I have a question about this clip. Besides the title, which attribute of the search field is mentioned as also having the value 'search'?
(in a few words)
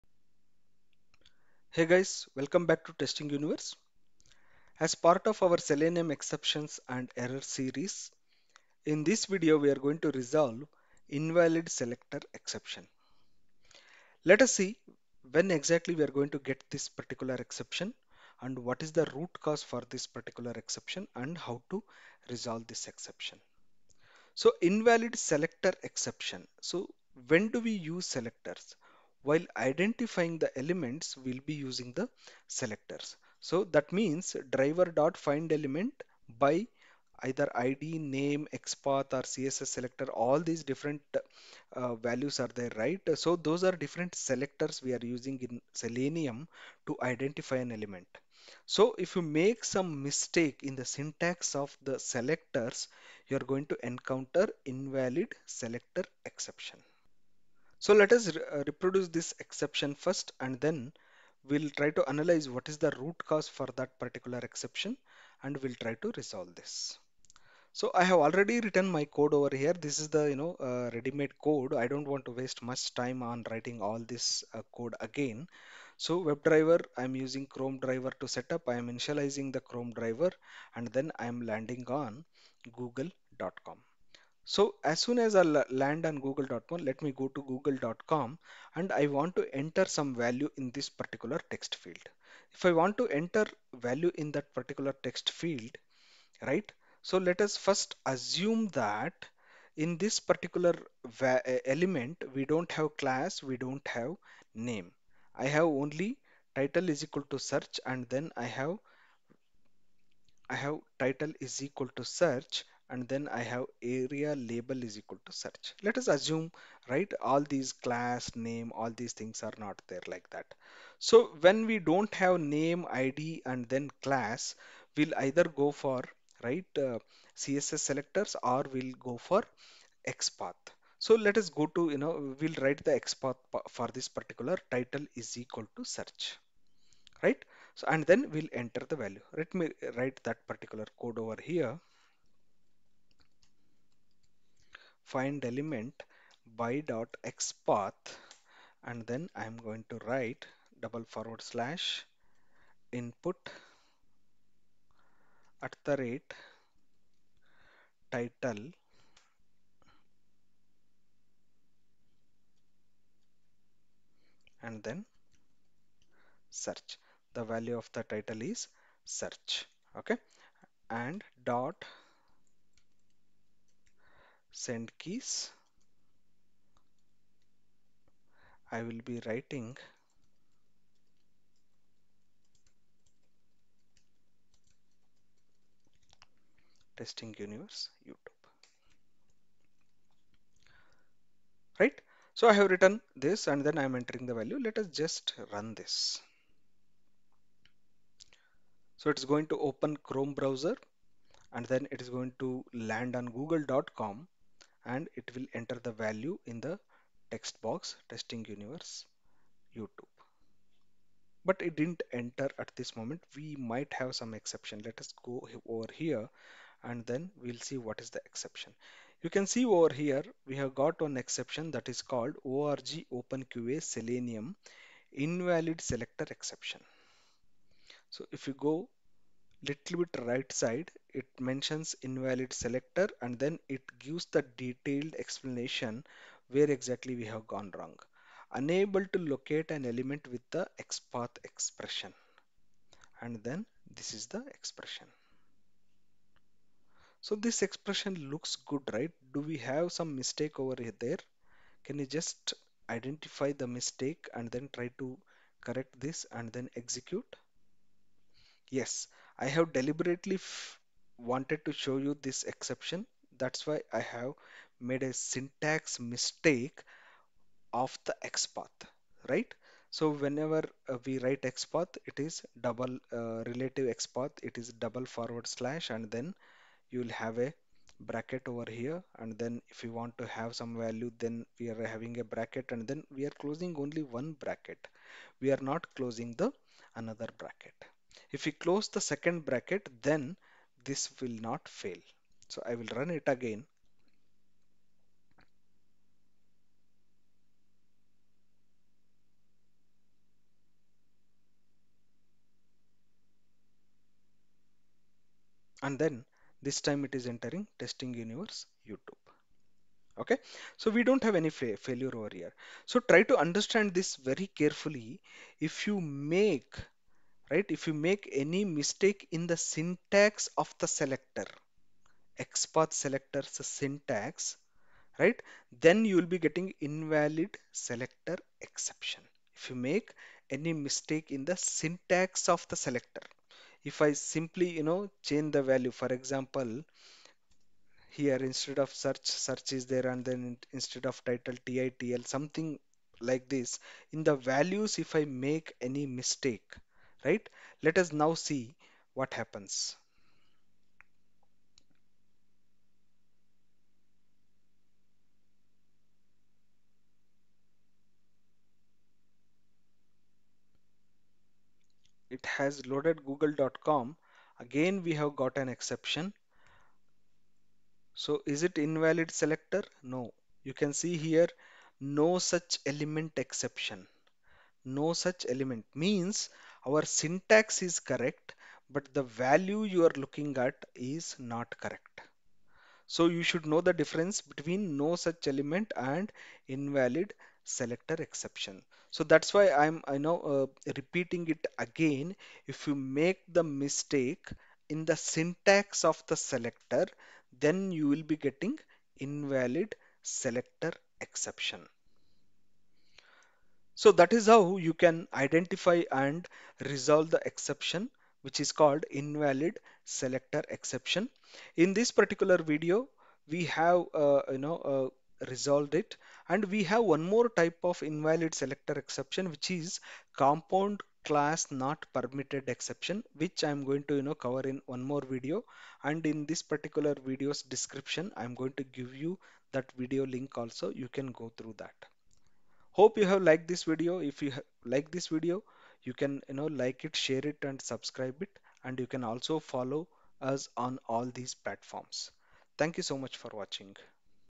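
aria label.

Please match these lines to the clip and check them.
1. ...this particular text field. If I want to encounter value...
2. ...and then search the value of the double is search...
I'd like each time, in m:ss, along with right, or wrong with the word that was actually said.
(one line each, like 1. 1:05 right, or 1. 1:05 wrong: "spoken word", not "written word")
1. 1:30 wrong: "enter", not "encounter"
2. 2:44 wrong: "title", not "double".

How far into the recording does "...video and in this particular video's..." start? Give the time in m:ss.
7:05.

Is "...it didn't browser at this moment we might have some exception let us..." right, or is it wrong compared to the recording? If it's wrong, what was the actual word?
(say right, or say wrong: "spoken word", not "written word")
wrong: "enter", not "browser".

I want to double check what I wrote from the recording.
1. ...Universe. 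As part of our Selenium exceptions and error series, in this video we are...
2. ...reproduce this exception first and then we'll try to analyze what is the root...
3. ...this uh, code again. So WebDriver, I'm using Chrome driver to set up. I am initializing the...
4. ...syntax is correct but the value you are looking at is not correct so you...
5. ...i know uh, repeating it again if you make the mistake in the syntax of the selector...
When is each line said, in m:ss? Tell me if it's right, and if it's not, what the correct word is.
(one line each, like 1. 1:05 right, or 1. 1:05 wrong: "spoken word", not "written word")
1. 0:03 right
2. 0:58 right
3. 1:14 right
4. 6:17 right
5. 6:30 right.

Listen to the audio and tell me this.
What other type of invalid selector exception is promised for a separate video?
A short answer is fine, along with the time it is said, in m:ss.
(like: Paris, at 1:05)
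compound class not permitted, at 7:00.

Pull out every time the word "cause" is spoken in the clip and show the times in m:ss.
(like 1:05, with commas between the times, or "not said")
0:19, 1:03.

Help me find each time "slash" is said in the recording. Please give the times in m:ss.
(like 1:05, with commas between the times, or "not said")
2:31, 4:35.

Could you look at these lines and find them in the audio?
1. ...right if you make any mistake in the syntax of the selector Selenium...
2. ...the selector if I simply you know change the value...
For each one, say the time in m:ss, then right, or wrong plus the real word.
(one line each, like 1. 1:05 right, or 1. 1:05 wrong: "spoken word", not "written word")
1. 5:17 wrong: "XPath", not "Selenium"
2. 5:32 right.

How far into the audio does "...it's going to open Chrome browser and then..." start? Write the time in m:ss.
3:19.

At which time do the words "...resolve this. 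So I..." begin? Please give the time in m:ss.
1:06.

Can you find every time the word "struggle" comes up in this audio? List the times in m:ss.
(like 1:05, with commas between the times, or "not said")
not said.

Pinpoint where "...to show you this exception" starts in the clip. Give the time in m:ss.
4:21.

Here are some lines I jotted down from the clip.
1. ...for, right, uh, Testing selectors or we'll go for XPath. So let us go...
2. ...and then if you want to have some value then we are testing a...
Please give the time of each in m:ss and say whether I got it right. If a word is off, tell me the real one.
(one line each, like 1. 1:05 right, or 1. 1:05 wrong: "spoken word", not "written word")
1. 2:05 wrong: "CSS", not "Testing"
2. 4:39 wrong: "having", not "testing".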